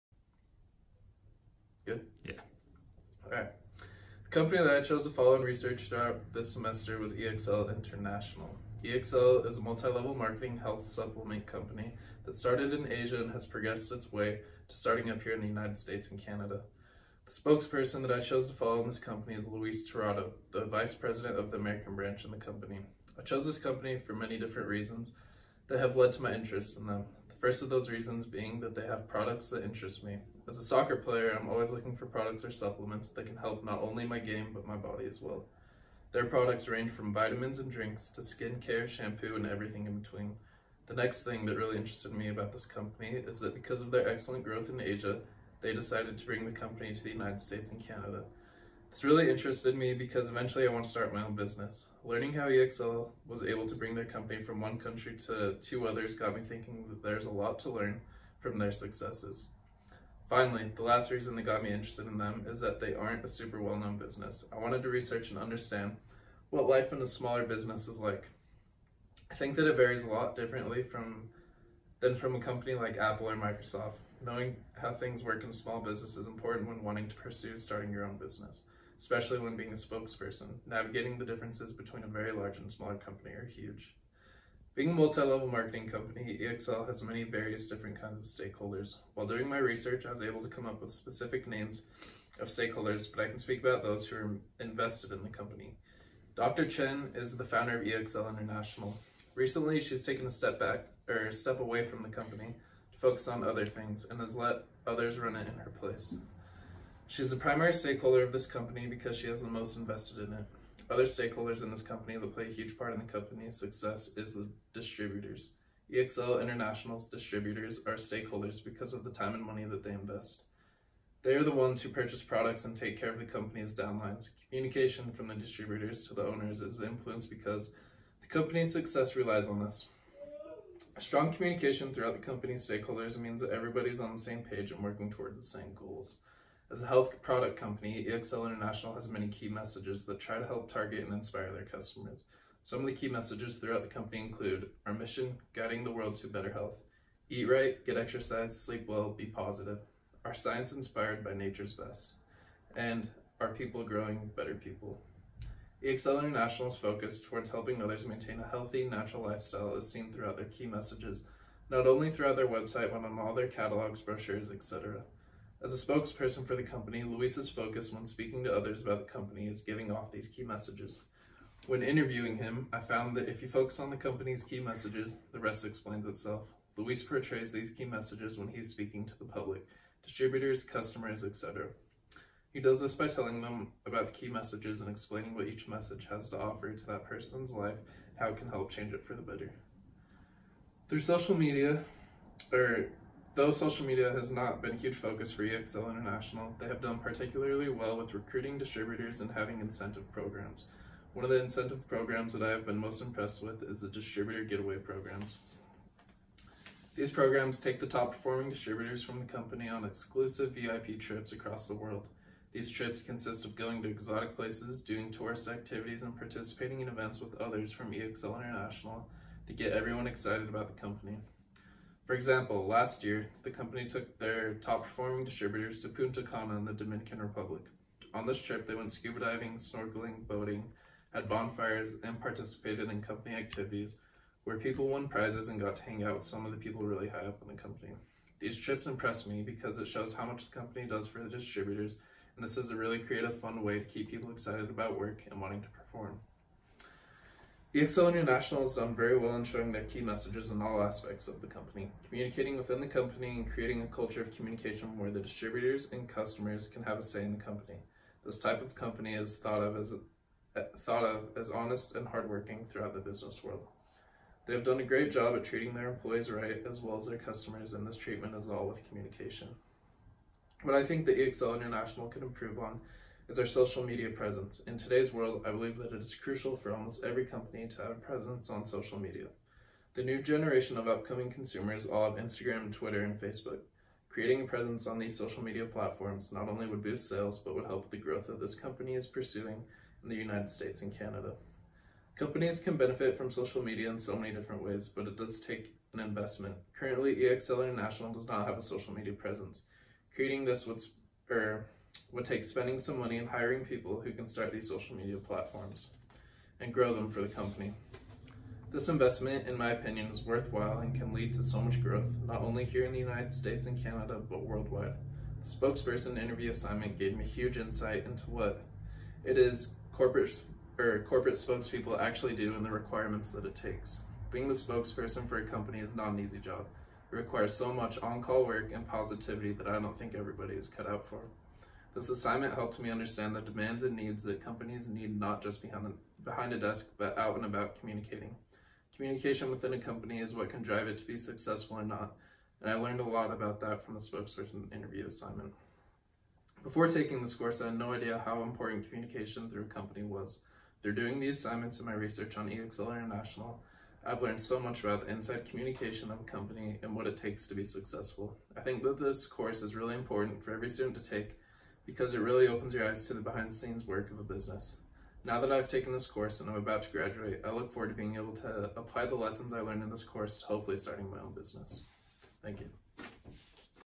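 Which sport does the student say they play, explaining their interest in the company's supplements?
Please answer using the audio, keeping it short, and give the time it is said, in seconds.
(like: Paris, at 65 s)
Soccer, at 30 s.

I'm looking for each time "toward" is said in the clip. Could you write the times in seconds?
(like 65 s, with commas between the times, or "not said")
135 s, 157 s.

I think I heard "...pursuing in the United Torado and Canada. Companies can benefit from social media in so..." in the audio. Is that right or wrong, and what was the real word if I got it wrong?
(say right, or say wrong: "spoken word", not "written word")
wrong: "States", not "Torado".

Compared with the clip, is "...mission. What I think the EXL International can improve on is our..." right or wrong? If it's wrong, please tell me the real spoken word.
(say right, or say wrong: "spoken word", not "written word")
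wrong: "communication", not "mission".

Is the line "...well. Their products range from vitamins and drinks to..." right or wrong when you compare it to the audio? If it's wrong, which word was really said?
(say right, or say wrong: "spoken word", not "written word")
right.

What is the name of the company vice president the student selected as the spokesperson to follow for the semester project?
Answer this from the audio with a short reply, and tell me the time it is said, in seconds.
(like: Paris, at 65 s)
Luis Torado, at 19 s.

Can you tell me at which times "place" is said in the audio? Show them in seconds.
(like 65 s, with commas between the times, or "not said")
105 s, 214 s.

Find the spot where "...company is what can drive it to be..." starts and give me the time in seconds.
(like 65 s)
339 s.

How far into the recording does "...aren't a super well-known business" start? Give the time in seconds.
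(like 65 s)
62 s.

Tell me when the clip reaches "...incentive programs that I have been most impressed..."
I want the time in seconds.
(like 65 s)
201 s.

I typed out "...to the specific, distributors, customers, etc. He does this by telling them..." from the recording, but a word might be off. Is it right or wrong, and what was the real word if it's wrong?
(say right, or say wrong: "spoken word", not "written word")
wrong: "public", not "specific".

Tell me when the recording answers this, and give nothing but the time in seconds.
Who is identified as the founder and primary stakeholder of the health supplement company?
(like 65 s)
96 s.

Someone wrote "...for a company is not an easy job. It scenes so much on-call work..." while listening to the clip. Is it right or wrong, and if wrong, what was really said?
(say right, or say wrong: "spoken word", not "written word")
wrong: "requires", not "scenes".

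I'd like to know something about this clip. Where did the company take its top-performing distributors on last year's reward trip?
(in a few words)
Punta Cana.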